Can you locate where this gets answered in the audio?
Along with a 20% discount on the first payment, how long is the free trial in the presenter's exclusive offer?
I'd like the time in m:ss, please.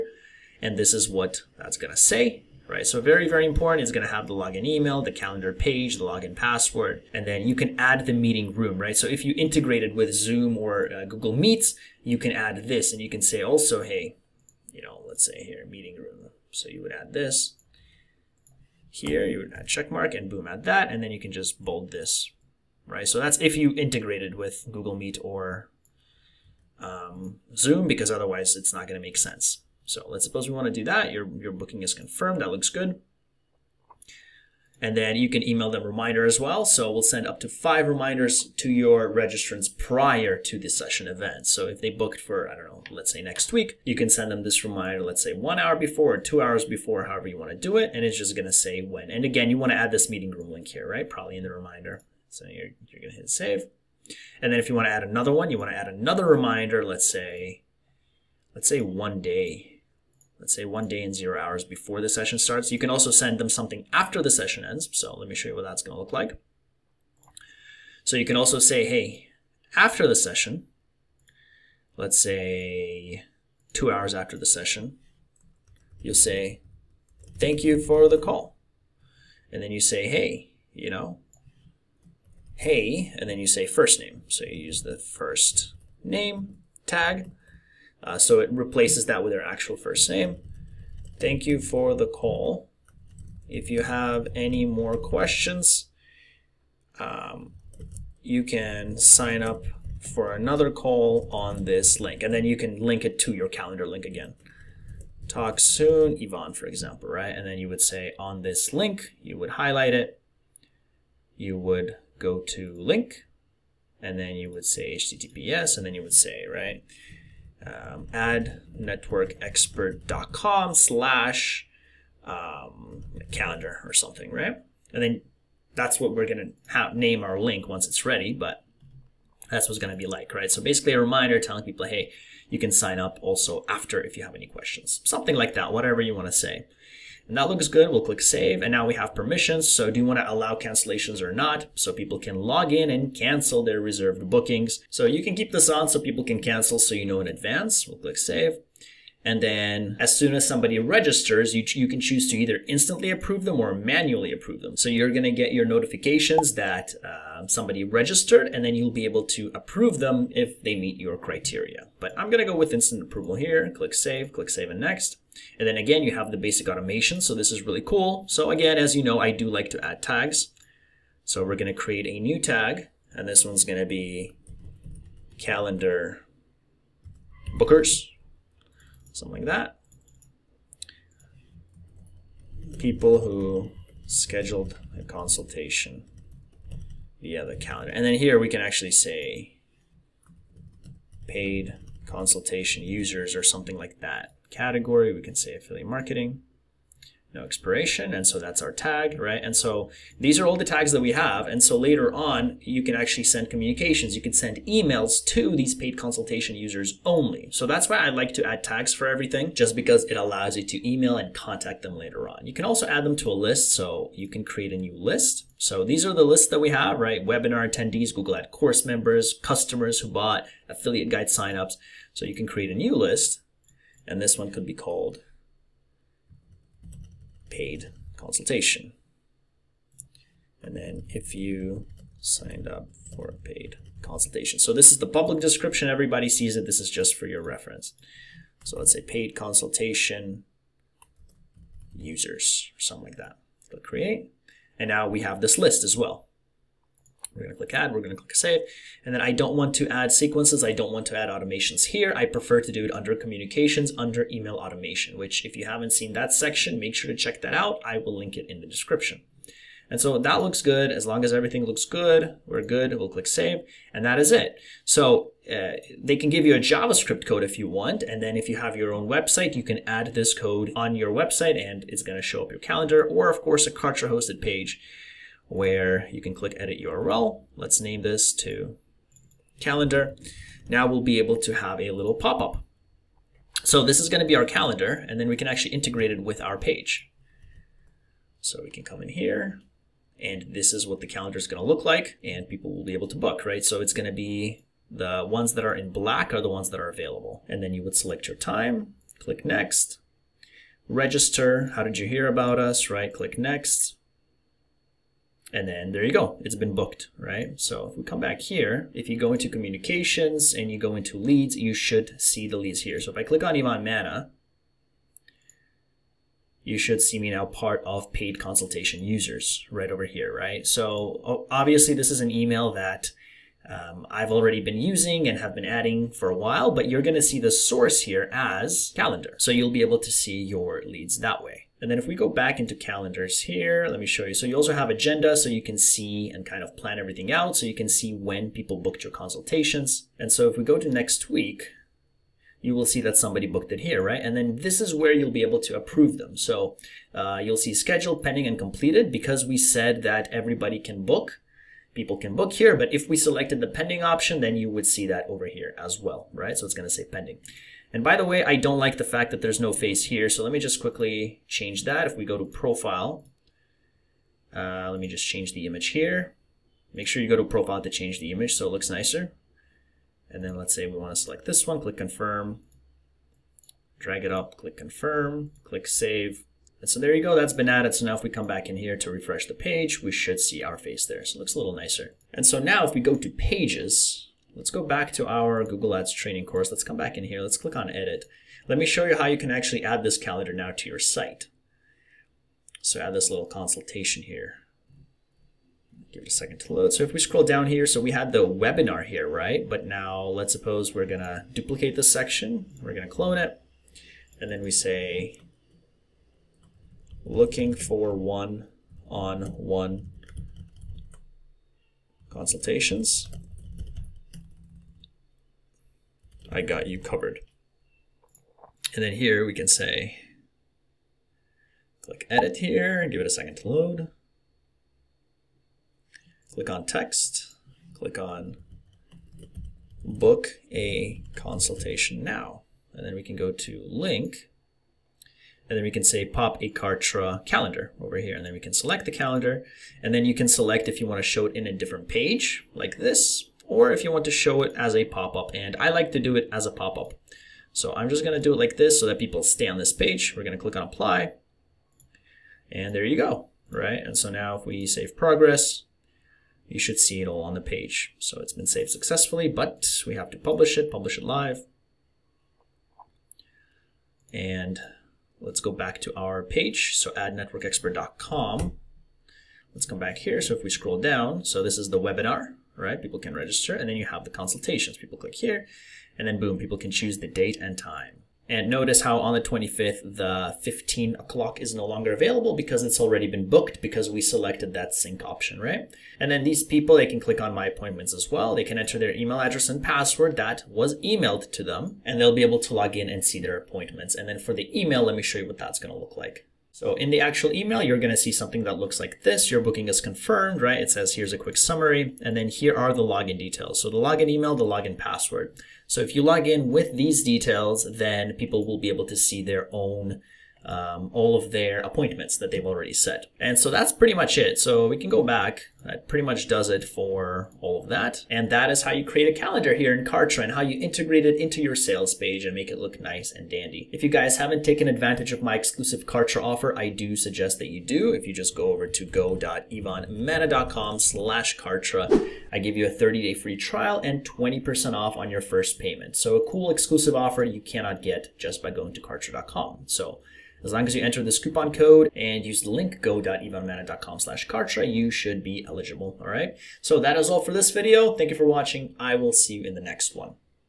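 8:52.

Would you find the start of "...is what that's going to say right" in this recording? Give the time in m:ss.
0:00.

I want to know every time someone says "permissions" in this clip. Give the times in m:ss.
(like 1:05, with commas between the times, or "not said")
2:19.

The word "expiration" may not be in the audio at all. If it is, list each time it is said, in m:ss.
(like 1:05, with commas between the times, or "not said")
3:17.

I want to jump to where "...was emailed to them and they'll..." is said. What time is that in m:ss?
8:10.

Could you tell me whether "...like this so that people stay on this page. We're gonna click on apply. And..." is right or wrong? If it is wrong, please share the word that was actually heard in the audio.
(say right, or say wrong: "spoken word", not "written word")
right.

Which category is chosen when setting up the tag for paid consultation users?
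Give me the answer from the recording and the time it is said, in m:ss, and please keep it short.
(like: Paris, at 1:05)
Affiliate marketing, at 3:15.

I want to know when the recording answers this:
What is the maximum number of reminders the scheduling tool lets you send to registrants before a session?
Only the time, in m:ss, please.
0:37.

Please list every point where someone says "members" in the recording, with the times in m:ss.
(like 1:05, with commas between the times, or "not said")
3:38.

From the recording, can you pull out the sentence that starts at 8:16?
So in the actual email, you're going to see something that looks like this.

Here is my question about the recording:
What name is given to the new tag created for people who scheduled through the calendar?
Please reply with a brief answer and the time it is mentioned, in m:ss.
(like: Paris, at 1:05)
Calendar bookers, at 2:55.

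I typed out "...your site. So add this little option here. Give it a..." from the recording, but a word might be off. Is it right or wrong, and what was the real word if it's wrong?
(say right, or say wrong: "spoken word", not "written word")
wrong: "consultation", not "option".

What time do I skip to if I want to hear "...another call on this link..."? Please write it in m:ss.
1:40.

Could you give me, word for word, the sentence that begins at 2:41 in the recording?
But I'm going to go with instant approval here.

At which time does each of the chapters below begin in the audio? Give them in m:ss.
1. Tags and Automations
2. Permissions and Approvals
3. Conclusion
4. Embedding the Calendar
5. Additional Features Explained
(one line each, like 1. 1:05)
1. 2:48
2. 2:17
3. 8:33
4. 4:24
5. 5:08.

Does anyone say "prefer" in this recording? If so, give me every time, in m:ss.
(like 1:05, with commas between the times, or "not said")
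4:12.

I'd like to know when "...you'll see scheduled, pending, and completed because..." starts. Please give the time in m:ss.
5:47.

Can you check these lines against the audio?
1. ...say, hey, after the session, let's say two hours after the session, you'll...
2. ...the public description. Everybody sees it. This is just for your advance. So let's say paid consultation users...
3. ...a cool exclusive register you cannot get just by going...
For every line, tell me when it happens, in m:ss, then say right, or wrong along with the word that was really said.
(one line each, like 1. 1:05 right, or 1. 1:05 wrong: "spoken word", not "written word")
1. 1:08 right
2. 3:54 wrong: "reference", not "advance"
3. 8:56 wrong: "offer", not "register".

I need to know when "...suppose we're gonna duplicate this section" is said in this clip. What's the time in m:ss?
6:40.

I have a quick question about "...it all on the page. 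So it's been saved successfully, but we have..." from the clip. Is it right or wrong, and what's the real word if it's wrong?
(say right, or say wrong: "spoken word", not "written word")
right.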